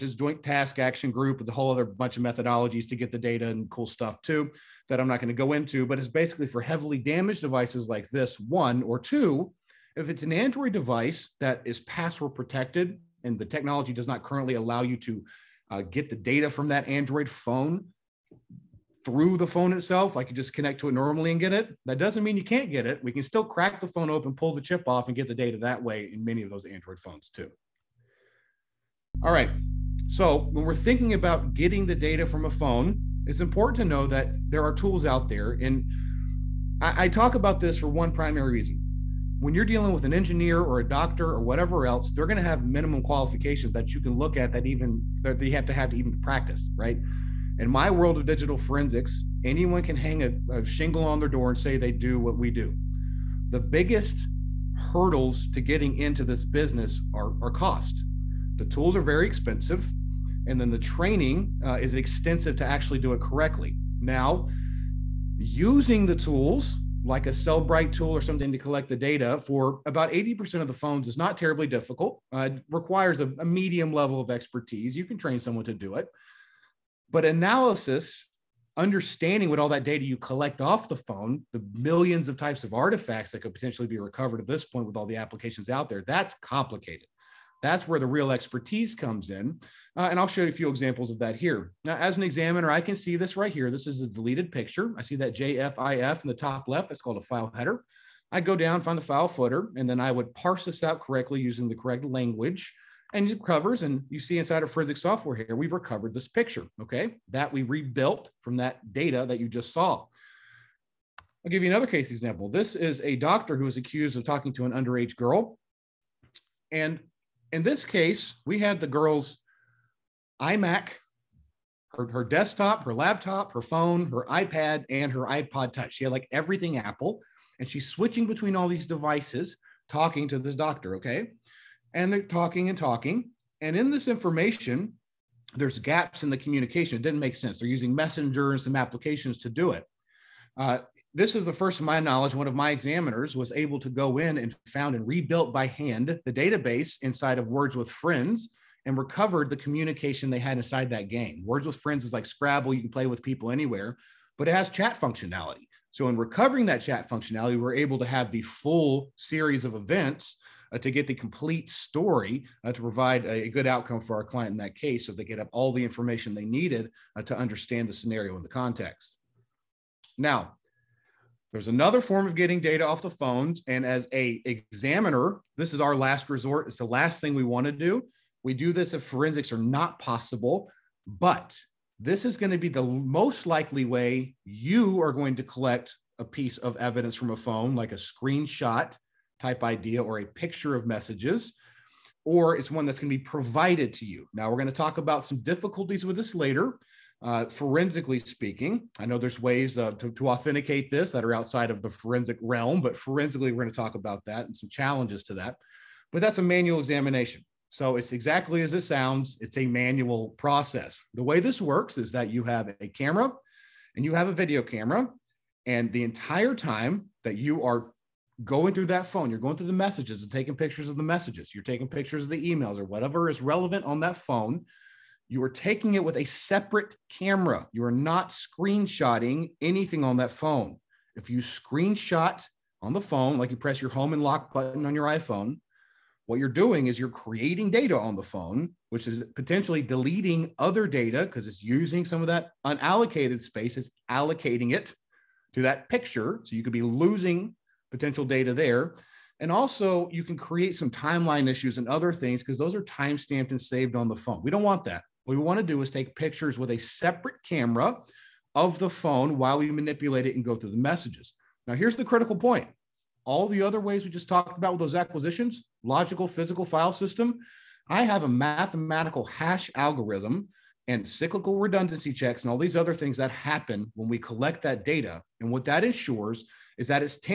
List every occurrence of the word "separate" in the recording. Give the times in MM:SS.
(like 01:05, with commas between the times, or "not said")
03:46, 04:16.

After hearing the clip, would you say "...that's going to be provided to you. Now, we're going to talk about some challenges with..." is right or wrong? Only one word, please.
wrong.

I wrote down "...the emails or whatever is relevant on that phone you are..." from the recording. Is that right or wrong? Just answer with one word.
right.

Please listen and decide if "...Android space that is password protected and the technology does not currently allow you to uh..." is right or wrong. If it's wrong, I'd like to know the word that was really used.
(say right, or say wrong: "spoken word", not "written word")
wrong: "device", not "space".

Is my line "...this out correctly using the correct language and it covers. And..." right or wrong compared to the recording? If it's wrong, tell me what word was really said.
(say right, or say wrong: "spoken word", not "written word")
right.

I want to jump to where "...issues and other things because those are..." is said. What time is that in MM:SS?
04:11.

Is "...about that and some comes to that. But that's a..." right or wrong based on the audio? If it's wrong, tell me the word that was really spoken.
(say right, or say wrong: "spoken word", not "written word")
wrong: "challenges", not "comes".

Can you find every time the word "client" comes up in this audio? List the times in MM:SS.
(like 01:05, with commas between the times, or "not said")
02:44.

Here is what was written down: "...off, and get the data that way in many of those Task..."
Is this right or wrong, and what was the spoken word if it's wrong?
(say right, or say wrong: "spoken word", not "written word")
wrong: "Android", not "Task".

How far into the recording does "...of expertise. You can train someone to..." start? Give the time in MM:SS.
01:14.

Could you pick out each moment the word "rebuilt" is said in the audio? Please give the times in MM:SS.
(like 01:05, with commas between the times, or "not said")
01:47, 02:25.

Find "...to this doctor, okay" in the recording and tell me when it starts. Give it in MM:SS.
02:10.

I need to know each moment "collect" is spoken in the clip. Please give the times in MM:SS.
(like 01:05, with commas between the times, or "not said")
01:08, 01:20, 03:05, 04:34.